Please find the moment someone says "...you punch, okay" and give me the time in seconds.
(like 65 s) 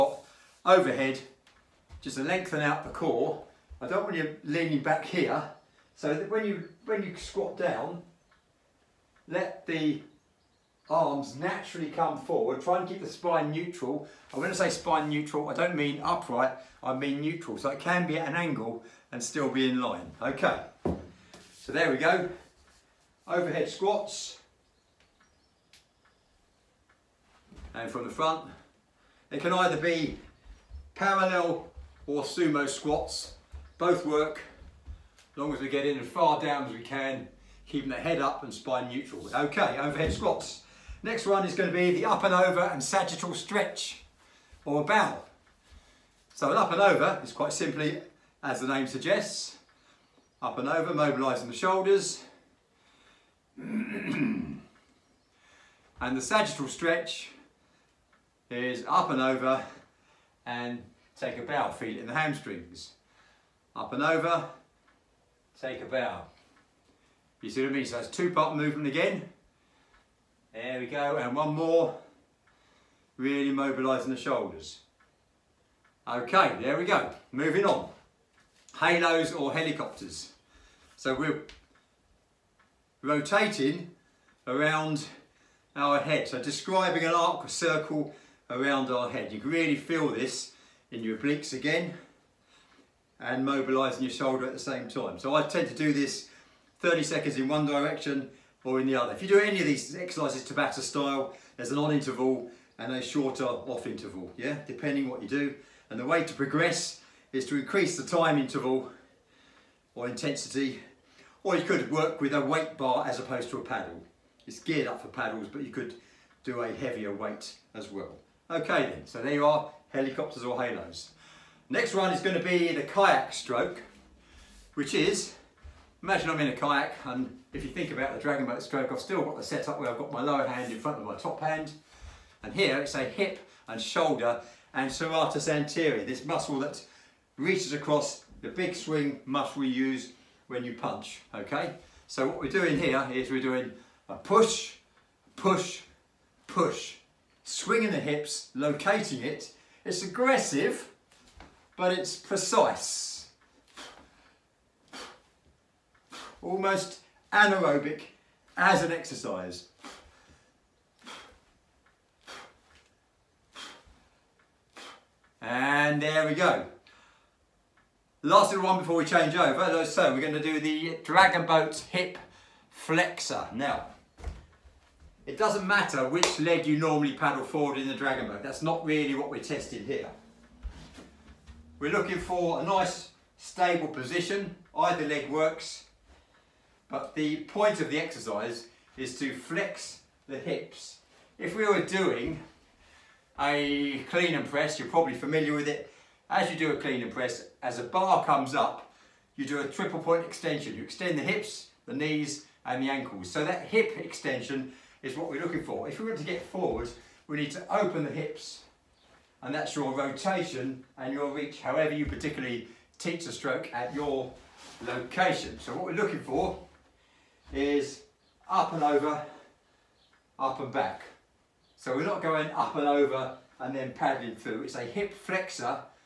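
140 s.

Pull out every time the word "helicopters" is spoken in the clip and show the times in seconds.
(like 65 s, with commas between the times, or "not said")
79 s, 119 s.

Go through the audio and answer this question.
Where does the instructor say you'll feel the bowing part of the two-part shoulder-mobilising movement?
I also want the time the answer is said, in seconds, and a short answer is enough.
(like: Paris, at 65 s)
hamstrings, at 62 s.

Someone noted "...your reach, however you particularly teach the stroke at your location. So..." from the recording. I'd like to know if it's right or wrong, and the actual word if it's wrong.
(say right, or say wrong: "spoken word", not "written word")
right.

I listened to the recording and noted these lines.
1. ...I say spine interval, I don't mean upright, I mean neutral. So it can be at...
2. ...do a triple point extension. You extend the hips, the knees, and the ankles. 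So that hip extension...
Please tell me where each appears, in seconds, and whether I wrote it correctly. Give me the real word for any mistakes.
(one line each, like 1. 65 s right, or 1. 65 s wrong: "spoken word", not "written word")
1. 14 s wrong: "neutral", not "interval"
2. 199 s right.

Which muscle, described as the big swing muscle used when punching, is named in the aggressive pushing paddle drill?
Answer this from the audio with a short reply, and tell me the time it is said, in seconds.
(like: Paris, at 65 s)
serratus anterior, at 134 s.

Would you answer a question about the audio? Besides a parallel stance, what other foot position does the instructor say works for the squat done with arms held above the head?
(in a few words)
sumo.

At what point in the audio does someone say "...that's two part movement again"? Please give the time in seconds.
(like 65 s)
67 s.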